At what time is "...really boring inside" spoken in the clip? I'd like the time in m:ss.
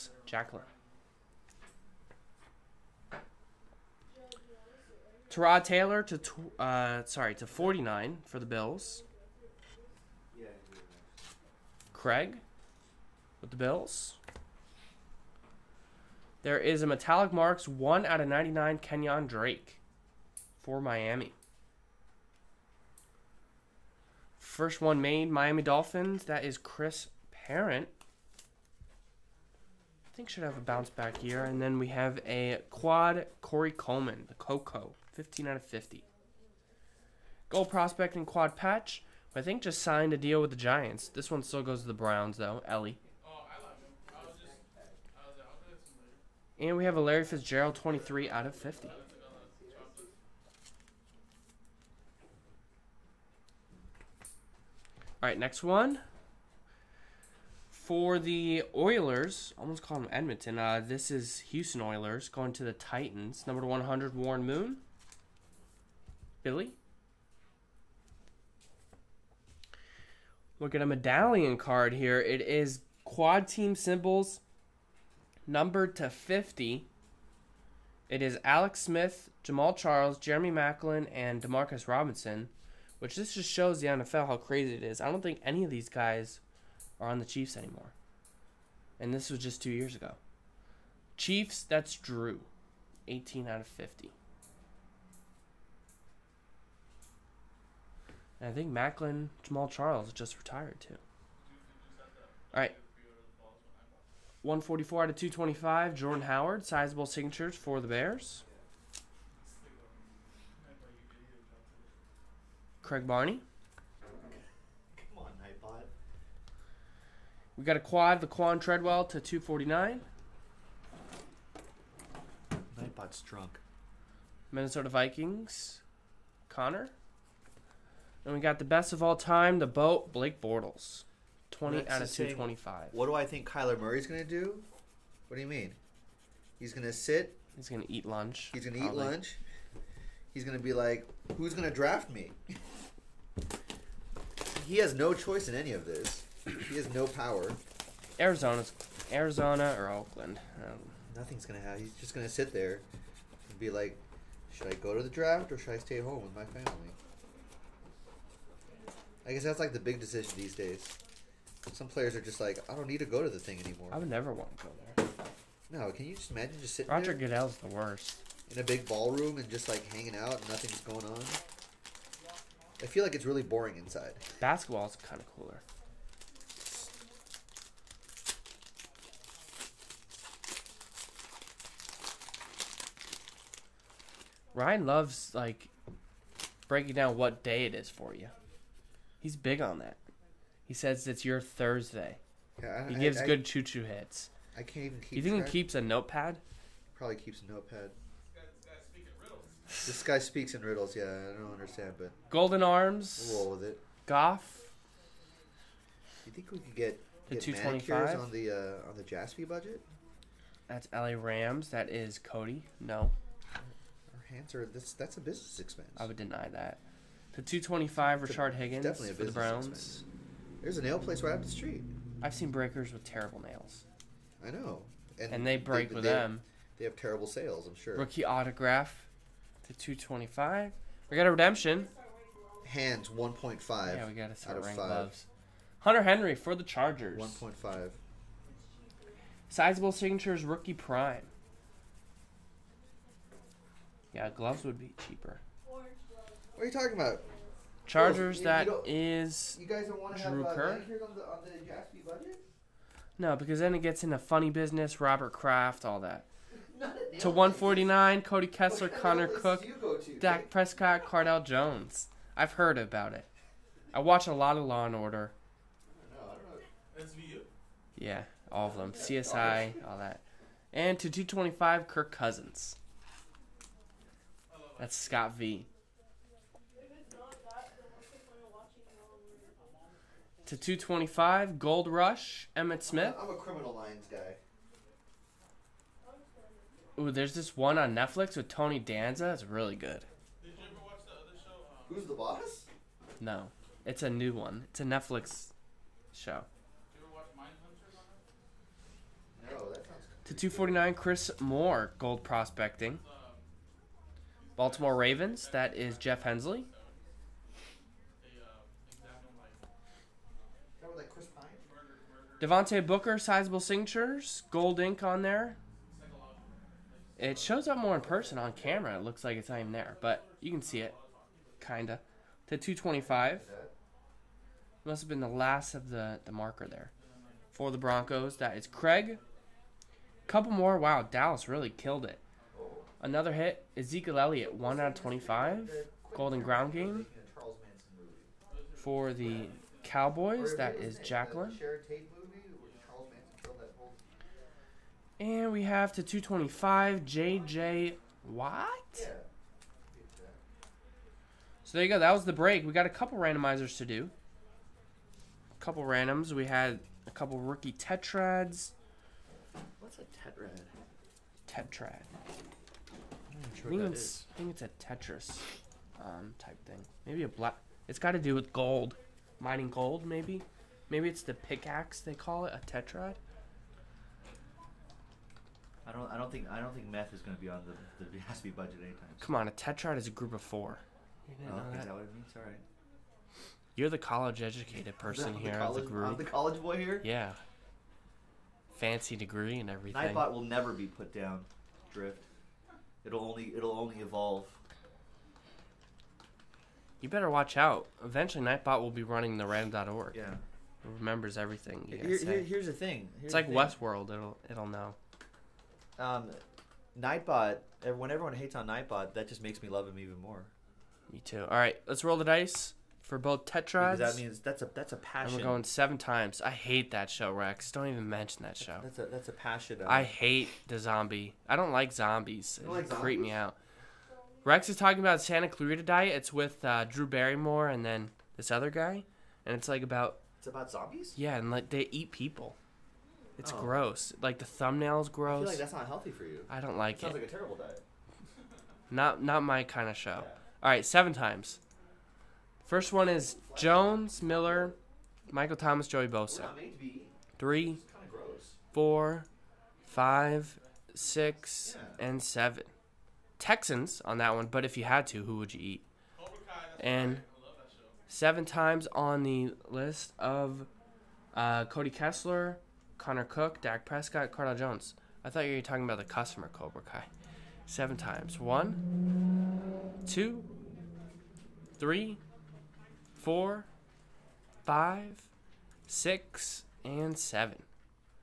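2:53.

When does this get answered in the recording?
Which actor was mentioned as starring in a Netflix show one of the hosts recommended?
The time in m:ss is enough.
4:48.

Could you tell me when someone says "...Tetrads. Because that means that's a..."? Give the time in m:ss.
6:53.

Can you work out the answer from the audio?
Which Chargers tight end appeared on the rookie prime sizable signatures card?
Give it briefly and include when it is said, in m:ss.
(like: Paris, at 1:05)
Hunter Henry, at 3:55.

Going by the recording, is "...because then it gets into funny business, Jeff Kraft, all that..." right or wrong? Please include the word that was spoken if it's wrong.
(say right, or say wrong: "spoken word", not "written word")
wrong: "Robert", not "Jeff".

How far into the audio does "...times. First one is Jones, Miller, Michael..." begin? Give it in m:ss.
7:21.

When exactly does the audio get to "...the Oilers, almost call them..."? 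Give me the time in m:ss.
0:58.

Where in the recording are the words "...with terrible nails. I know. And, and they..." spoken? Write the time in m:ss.
3:42.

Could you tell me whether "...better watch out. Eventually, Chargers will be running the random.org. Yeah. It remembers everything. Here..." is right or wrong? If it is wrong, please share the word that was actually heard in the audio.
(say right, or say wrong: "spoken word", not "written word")
wrong: "Nightbot", not "Chargers".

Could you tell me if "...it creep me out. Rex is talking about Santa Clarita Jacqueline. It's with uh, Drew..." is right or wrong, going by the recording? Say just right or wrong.
wrong.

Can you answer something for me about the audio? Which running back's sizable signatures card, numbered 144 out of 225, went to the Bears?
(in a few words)
Jordan Howard.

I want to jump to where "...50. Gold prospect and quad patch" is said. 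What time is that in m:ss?
0:35.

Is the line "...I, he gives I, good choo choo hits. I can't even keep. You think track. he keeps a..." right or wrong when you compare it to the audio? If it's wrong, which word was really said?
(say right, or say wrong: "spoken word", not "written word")
right.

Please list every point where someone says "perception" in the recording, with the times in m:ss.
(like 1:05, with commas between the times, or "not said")
not said.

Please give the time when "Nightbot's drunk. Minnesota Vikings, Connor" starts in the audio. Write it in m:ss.
2:02.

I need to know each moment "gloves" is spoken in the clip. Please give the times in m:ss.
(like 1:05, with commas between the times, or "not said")
3:54, 4:04.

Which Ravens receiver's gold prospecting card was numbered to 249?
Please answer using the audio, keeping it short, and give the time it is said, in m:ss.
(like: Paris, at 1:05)
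Chris Moore, at 5:00.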